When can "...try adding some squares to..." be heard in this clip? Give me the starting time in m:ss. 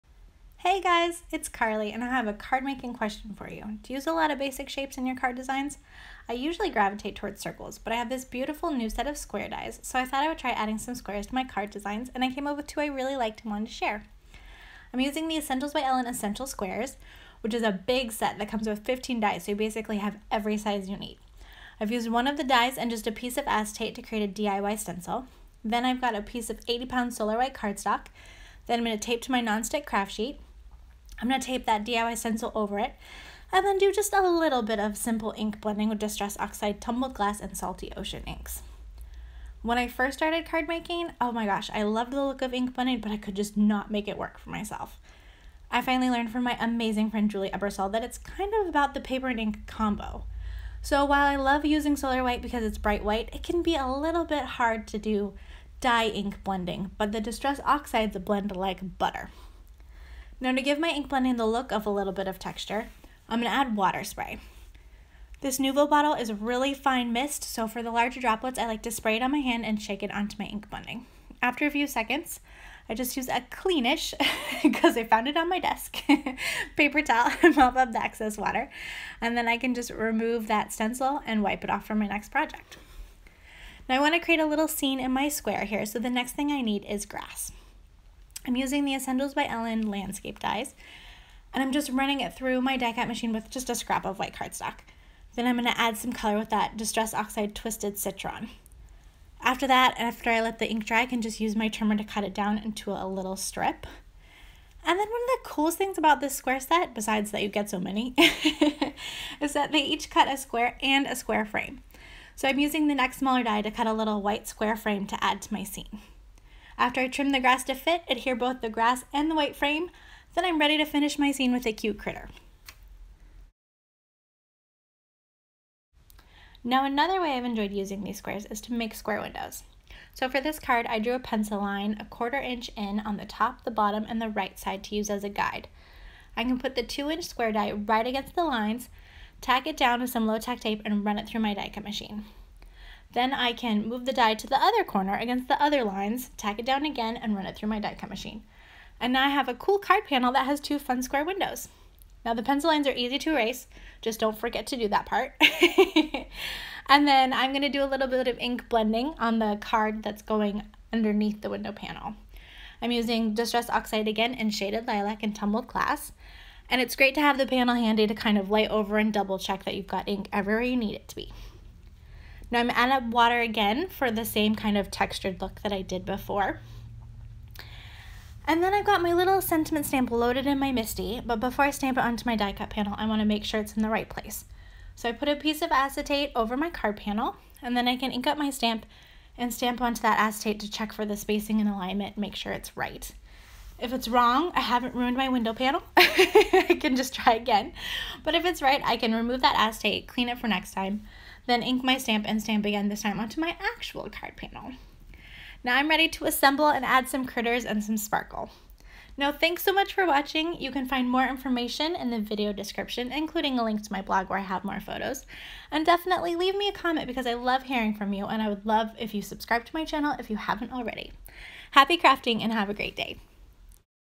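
0:10.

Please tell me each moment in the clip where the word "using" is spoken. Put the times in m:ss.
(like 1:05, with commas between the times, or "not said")
0:14, 0:51, 1:28, 1:52, 2:07, 2:42.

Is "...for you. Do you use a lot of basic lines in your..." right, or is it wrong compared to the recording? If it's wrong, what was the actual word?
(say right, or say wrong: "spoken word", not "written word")
wrong: "shapes", not "lines".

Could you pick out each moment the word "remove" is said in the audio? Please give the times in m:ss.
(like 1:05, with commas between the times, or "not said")
1:19, 3:19.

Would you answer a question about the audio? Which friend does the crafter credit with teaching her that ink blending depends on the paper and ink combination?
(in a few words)
Julie Ebersole.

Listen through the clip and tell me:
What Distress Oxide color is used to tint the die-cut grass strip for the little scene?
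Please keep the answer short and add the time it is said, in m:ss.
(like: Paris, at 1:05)
Twisted Citron, at 1:37.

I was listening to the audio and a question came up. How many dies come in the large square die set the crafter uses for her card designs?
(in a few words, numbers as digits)
15.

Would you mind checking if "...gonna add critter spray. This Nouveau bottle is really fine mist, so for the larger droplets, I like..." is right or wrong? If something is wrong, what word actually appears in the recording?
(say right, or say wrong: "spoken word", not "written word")
wrong: "water", not "critter".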